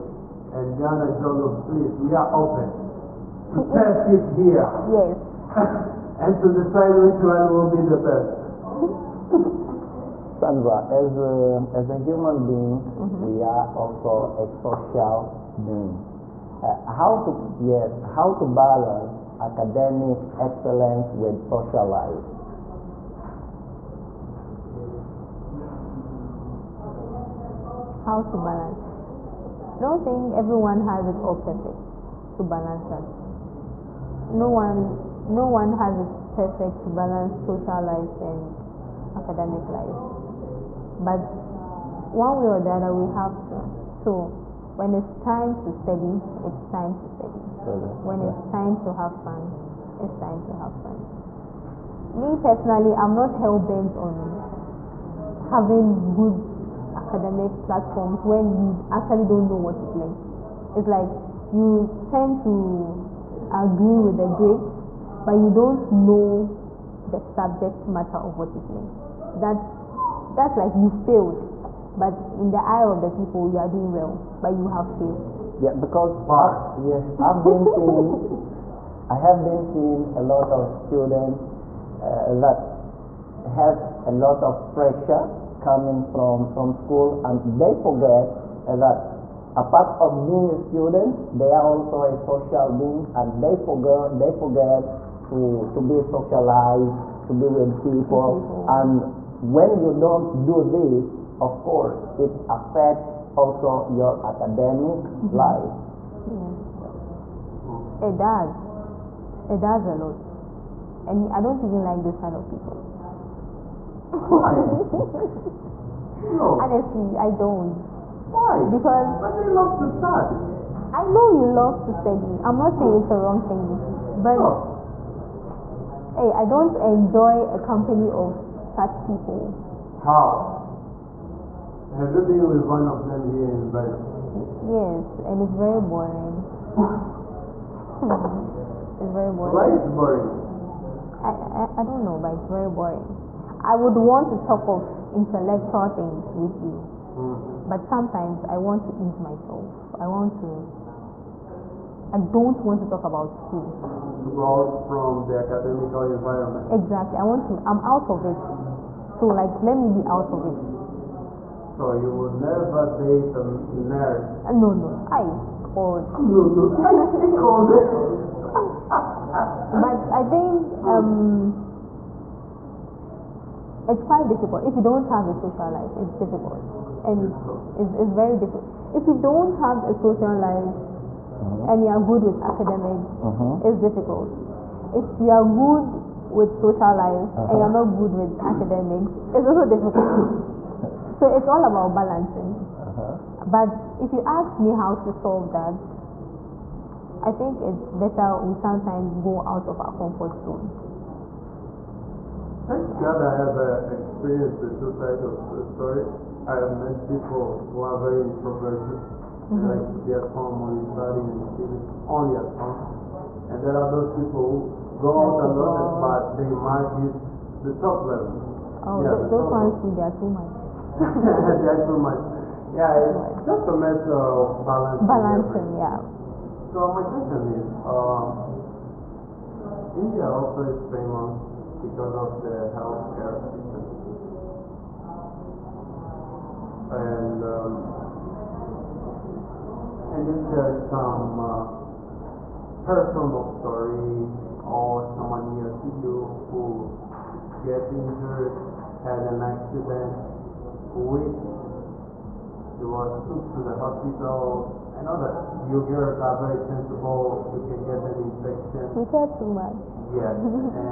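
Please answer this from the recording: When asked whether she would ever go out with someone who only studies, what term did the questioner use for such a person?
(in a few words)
nerd.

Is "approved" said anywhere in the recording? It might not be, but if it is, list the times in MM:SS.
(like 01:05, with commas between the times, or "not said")
not said.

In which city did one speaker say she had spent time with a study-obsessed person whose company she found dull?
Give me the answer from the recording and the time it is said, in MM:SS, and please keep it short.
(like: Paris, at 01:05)
Dubai, at 02:13.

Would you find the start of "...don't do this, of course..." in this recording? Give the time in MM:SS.
01:39.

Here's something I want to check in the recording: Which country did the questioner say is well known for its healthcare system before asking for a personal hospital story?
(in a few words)
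India.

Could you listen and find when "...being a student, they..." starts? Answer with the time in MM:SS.
01:30.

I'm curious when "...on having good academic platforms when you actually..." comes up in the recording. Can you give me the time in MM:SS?
00:53.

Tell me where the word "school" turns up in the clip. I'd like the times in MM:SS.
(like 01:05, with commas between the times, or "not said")
01:26, 02:33.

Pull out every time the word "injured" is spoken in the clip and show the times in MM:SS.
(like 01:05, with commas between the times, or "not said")
04:07.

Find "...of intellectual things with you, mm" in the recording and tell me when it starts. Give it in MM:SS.
02:24.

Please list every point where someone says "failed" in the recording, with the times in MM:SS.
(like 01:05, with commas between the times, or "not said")
01:10, 01:14.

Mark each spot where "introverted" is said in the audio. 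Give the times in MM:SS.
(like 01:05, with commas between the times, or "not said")
03:28.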